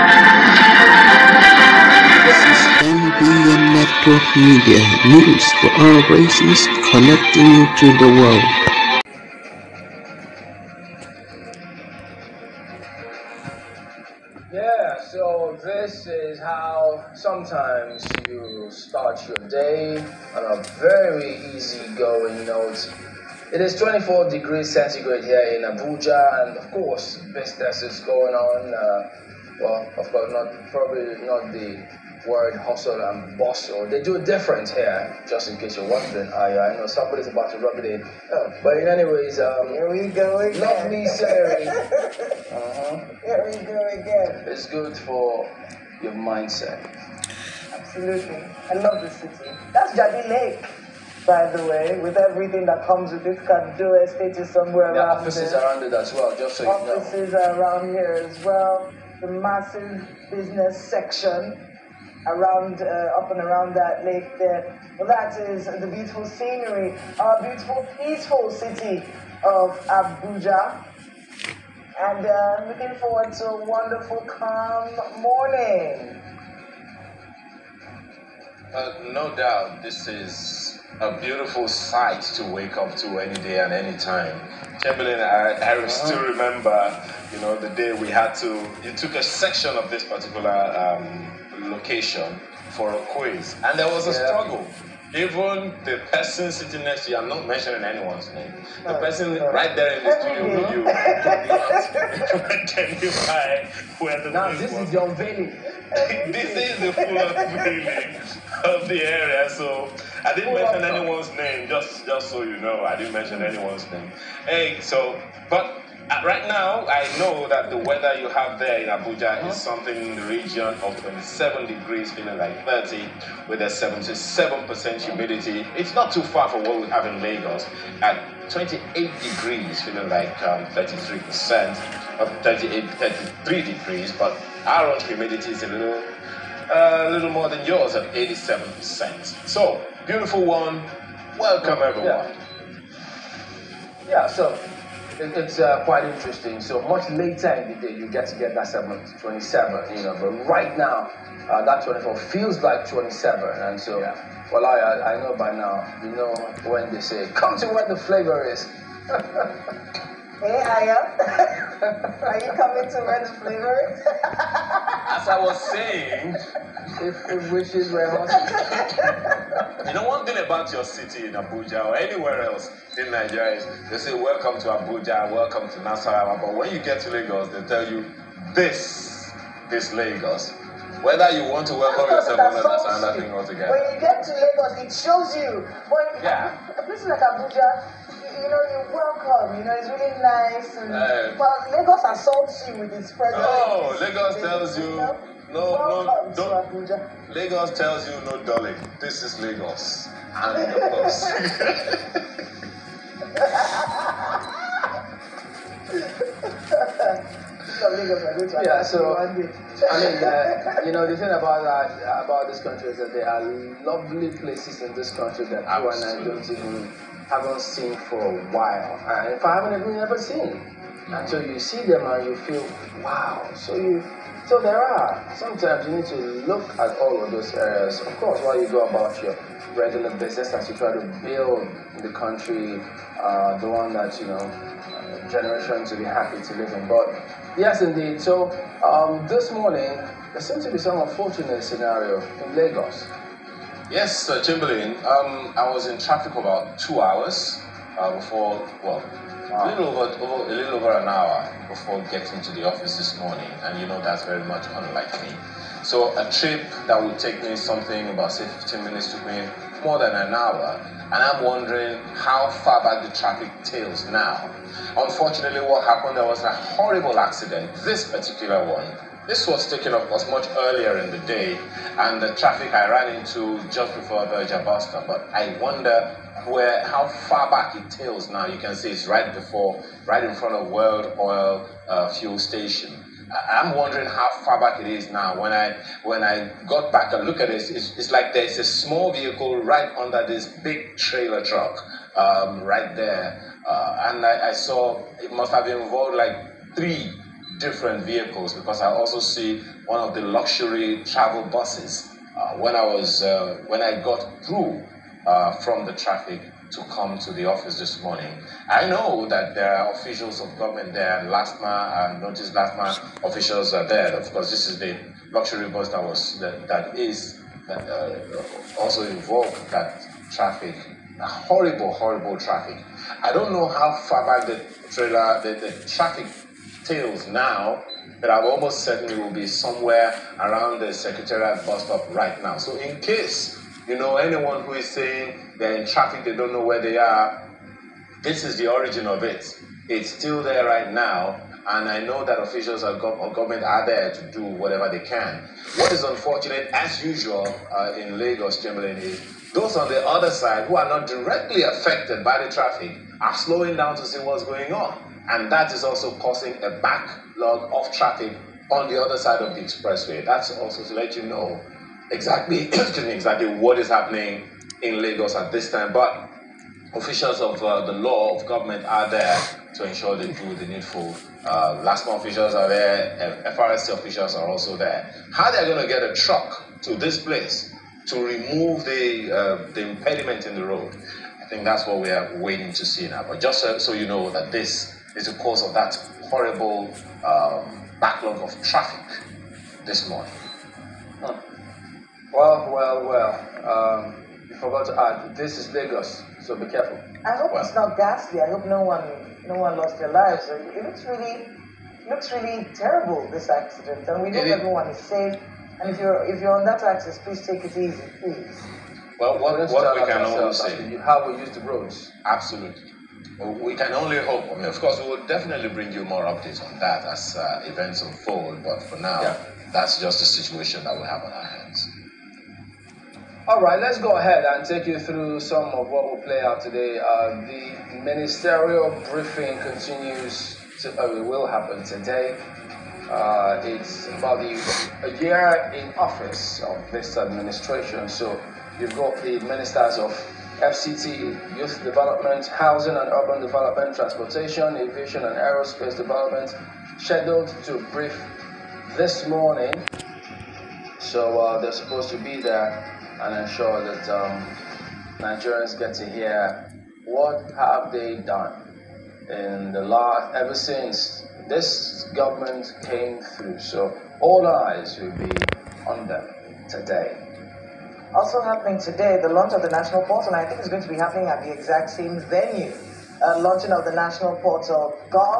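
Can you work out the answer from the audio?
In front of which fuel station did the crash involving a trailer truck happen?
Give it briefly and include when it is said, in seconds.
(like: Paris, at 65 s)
World Oil, at 280 s.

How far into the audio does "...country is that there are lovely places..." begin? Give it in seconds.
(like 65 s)
212 s.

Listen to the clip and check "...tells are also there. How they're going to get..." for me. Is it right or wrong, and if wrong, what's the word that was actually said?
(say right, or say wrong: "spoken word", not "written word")
wrong: "officials", not "tells".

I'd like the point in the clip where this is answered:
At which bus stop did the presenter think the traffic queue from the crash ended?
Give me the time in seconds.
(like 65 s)
330 s.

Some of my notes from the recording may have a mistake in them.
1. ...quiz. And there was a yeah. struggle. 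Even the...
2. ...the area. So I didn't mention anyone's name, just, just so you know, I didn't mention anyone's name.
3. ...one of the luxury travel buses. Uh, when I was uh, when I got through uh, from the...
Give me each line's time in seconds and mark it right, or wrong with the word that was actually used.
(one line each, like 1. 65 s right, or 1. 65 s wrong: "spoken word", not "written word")
1. 93 s right
2. 108 s right
3. 299 s right.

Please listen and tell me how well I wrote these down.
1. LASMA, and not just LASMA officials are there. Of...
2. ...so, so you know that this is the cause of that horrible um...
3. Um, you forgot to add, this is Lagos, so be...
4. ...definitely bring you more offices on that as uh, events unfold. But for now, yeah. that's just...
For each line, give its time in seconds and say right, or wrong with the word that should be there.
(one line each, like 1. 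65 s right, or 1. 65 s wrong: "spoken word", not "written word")
1. 311 s right
2. 383 s right
3. 394 s right
4. 415 s wrong: "updates", not "offices".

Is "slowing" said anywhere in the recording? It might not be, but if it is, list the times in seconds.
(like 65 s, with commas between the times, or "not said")
353 s.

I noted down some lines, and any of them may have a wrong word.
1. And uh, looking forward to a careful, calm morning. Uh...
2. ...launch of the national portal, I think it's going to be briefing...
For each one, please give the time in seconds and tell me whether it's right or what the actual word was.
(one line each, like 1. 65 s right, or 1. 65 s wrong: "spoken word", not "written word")
1. 71 s wrong: "wonderful", not "careful"
2. 469 s wrong: "happening", not "briefing".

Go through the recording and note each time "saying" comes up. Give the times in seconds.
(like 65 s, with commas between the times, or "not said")
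165 s, 334 s.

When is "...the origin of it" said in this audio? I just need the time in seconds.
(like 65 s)
338 s.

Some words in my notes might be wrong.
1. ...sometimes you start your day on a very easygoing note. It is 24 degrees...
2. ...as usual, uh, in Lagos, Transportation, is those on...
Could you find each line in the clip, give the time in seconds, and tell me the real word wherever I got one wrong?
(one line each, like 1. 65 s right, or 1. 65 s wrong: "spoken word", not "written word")
1. 17 s right
2. 346 s wrong: "Chamberlain", not "Transportation".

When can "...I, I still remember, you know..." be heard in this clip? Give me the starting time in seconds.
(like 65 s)
85 s.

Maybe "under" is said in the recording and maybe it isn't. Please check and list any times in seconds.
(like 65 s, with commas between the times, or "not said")
289 s.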